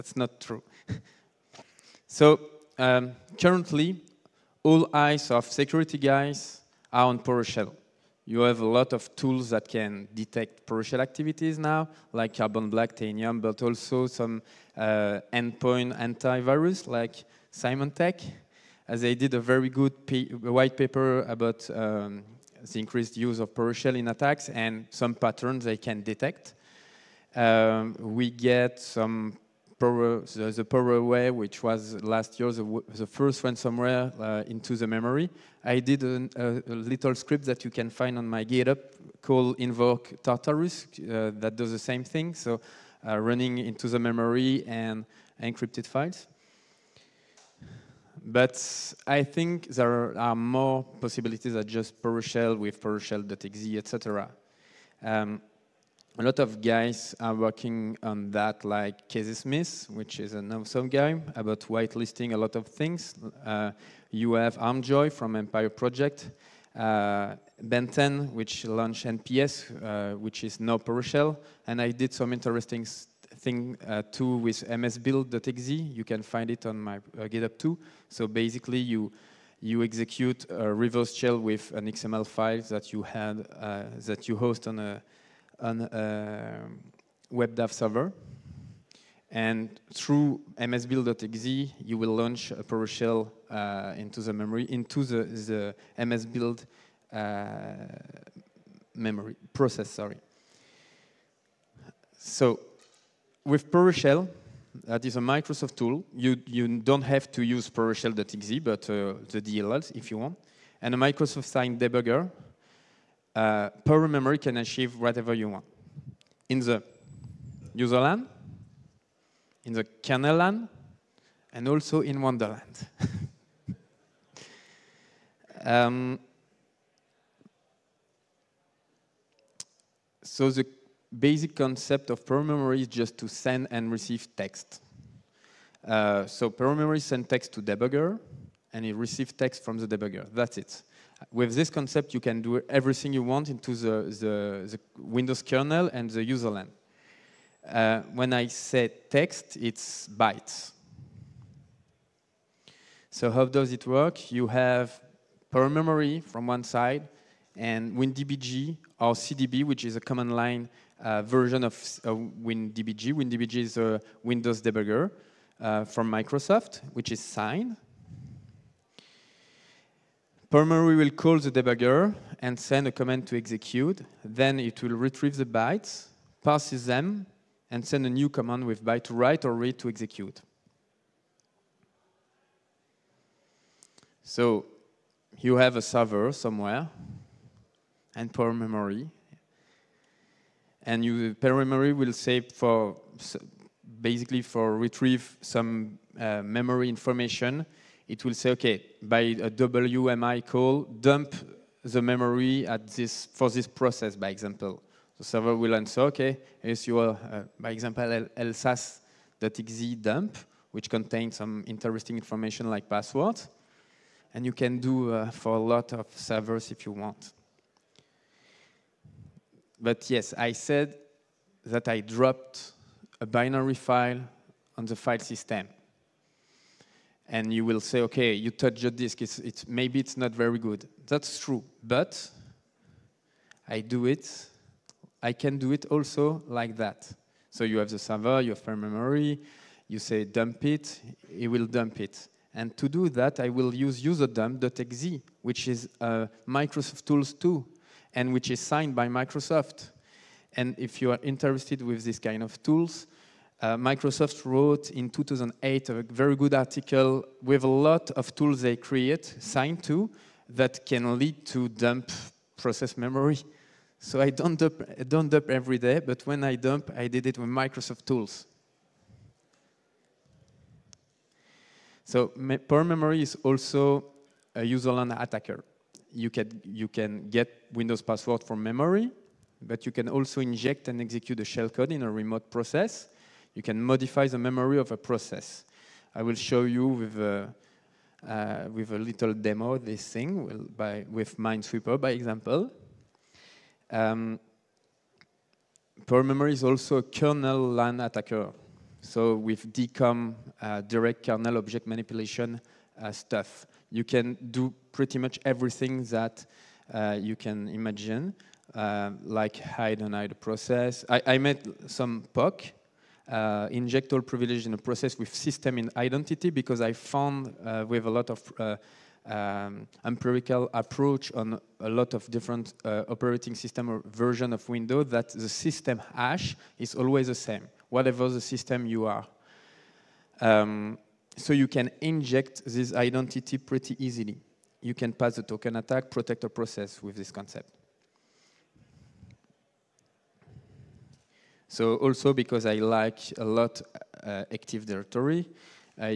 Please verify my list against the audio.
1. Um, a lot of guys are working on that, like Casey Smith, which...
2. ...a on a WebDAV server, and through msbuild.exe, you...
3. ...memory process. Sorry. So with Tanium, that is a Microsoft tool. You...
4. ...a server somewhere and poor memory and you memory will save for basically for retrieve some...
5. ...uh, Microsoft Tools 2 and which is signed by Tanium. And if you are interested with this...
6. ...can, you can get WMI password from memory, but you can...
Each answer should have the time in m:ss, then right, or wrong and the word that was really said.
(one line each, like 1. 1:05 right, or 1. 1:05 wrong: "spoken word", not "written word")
1. 0:55 right
2. 1:24 right
3. 1:38 wrong: "PowerShell", not "Tanium"
4. 3:05 right
5. 4:06 wrong: "Microsoft", not "Tanium"
6. 4:36 wrong: "Windows", not "WMI".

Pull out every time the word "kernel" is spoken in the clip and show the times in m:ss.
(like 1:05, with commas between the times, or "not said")
2:00, 2:25, 4:57, 5:01.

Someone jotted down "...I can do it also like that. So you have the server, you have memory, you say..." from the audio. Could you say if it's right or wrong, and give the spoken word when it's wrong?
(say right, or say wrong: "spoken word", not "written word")
right.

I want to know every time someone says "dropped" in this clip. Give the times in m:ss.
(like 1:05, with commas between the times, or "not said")
3:41.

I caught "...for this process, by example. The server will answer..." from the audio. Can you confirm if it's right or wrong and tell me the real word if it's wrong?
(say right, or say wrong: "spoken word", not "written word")
right.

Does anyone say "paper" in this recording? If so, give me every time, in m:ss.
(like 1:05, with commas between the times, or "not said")
0:20.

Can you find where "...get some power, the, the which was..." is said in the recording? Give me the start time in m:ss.
0:28.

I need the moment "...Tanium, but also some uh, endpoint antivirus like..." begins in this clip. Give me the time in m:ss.
0:12.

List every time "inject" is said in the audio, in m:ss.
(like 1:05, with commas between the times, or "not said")
4:40, 5:13, 5:32.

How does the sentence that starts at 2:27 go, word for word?
Uh, when I say text, it's bytes.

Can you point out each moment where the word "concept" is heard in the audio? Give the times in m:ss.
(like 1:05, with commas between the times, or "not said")
2:11, 2:21, 5:37.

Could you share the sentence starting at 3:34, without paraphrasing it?
And you can do uh, for a lot of servers if you want.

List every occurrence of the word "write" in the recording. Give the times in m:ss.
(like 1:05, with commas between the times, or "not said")
2:59.